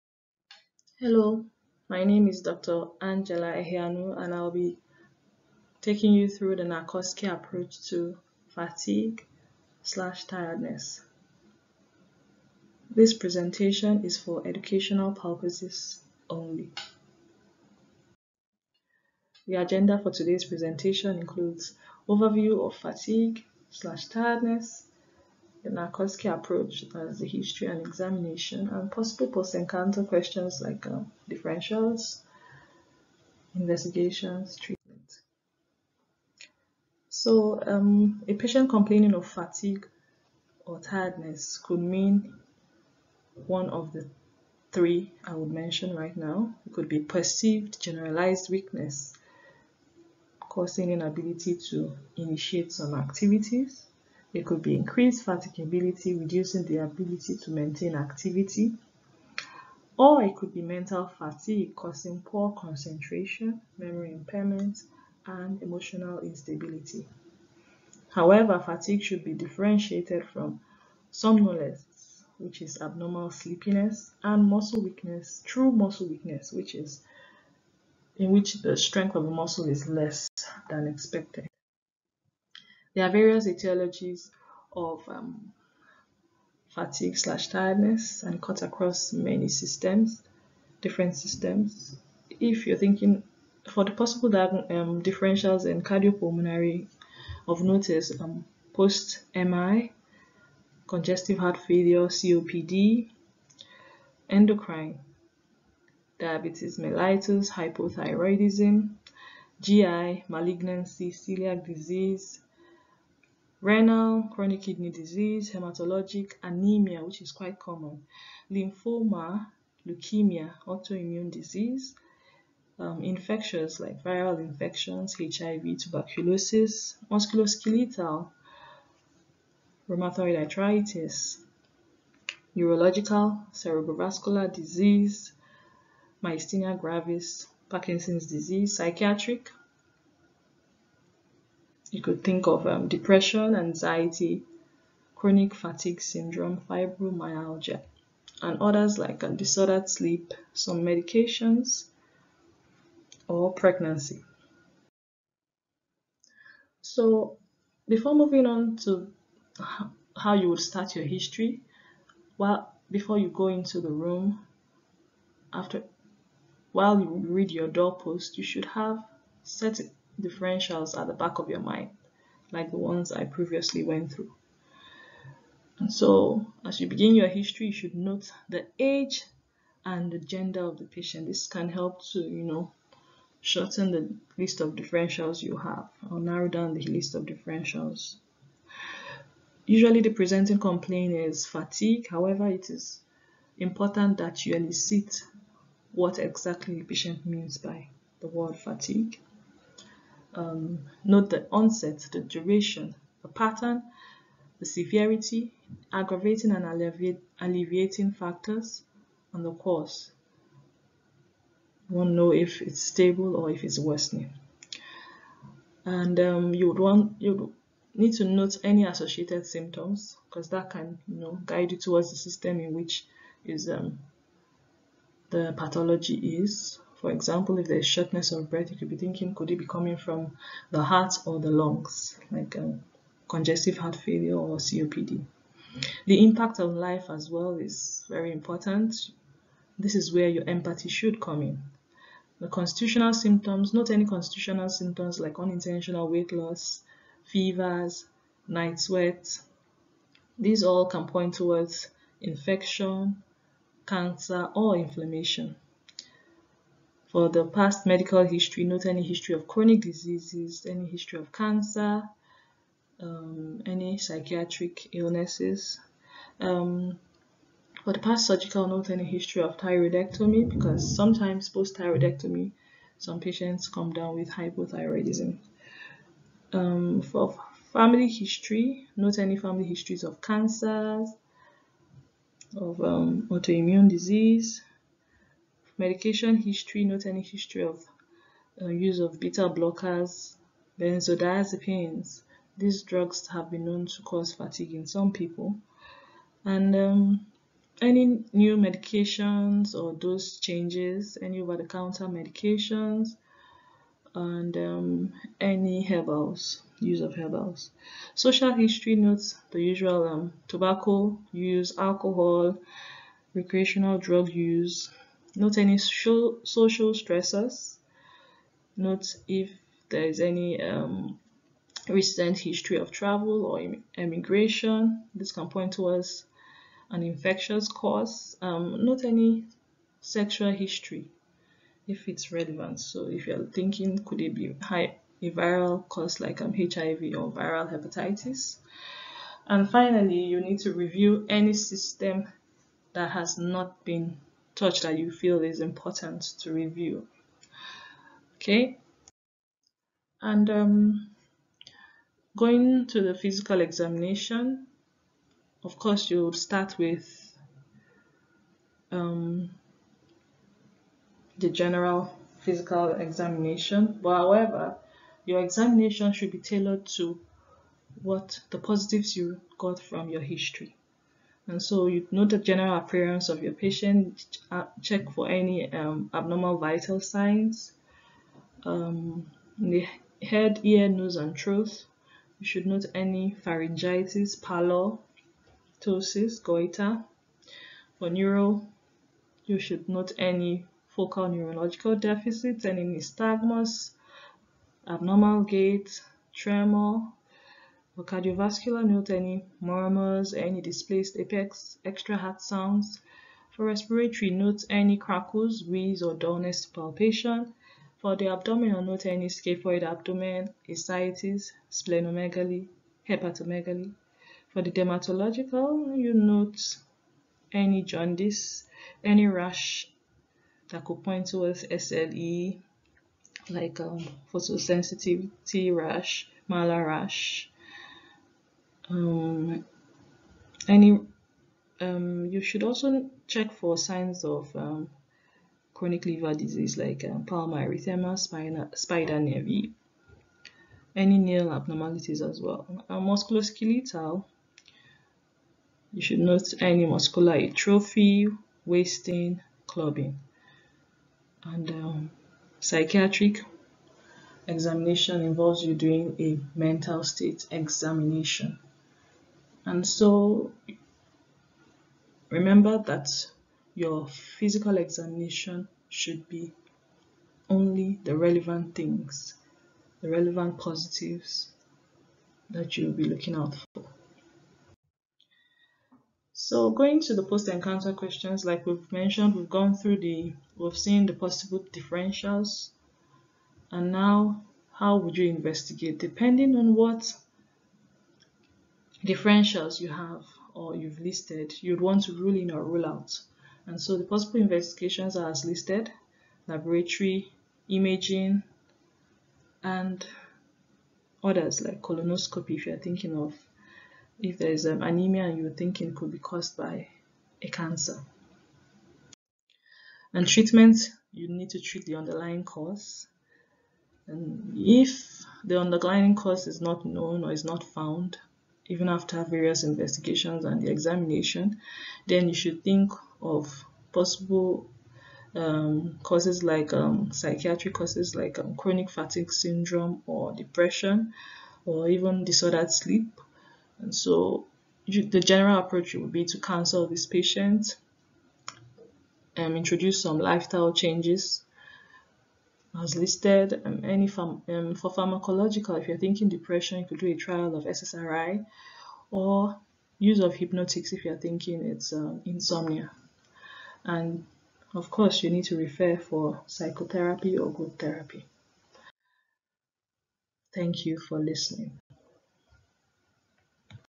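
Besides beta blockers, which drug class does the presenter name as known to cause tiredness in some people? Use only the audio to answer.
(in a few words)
Benzodiazepines.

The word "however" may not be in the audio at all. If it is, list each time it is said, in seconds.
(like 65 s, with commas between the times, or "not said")
68 s, 192 s, 364 s.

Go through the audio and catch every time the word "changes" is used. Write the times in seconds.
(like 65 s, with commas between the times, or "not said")
300 s, 540 s.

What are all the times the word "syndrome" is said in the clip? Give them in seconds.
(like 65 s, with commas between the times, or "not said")
146 s, 529 s.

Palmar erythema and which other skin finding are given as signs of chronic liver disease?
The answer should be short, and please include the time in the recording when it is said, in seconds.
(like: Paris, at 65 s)
Spider nevi, at 438 s.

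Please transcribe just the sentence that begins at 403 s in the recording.
For respiratory, note any crackles, wheeze, or dullness palpation.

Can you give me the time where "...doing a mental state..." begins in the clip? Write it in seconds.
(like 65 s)
455 s.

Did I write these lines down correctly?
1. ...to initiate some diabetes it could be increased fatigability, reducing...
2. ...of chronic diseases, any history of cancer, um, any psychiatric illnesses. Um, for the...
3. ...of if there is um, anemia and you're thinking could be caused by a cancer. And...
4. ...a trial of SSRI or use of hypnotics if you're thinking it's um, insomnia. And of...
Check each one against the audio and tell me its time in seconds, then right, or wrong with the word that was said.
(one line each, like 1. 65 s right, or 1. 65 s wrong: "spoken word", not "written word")
1. 51 s wrong: "activities", not "diabetes"
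2. 259 s right
3. 503 s right
4. 547 s right.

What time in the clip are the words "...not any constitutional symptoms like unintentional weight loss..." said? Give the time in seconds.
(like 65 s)
243 s.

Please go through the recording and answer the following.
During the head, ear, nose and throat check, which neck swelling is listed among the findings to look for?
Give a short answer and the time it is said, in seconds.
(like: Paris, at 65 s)
Goiter, at 386 s.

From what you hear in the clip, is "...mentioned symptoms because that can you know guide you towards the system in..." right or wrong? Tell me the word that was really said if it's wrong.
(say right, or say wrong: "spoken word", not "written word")
wrong: "associated", not "mentioned".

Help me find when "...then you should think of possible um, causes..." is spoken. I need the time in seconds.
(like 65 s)
522 s.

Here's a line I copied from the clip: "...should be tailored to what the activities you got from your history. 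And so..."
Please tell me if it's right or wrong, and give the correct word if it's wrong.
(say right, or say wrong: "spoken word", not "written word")
wrong: "positives", not "activities".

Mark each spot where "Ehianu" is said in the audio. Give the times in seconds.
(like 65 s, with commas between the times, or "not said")
3 s.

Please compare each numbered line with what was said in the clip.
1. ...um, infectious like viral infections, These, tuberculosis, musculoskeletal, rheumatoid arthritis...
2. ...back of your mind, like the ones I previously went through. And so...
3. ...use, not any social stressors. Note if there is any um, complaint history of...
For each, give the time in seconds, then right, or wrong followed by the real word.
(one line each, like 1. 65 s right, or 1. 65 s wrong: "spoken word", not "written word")
1. 122 s wrong: "HIV", not "These"
2. 171 s right
3. 314 s wrong: "recent", not "complaint".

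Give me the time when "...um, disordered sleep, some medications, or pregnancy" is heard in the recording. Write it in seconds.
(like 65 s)
149 s.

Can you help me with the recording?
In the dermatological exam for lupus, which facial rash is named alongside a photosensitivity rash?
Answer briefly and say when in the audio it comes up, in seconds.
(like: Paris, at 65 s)
Malar rash, at 426 s.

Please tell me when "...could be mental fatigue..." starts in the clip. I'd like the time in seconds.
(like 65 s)
60 s.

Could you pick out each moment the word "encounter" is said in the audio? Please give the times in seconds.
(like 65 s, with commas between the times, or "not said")
29 s, 477 s.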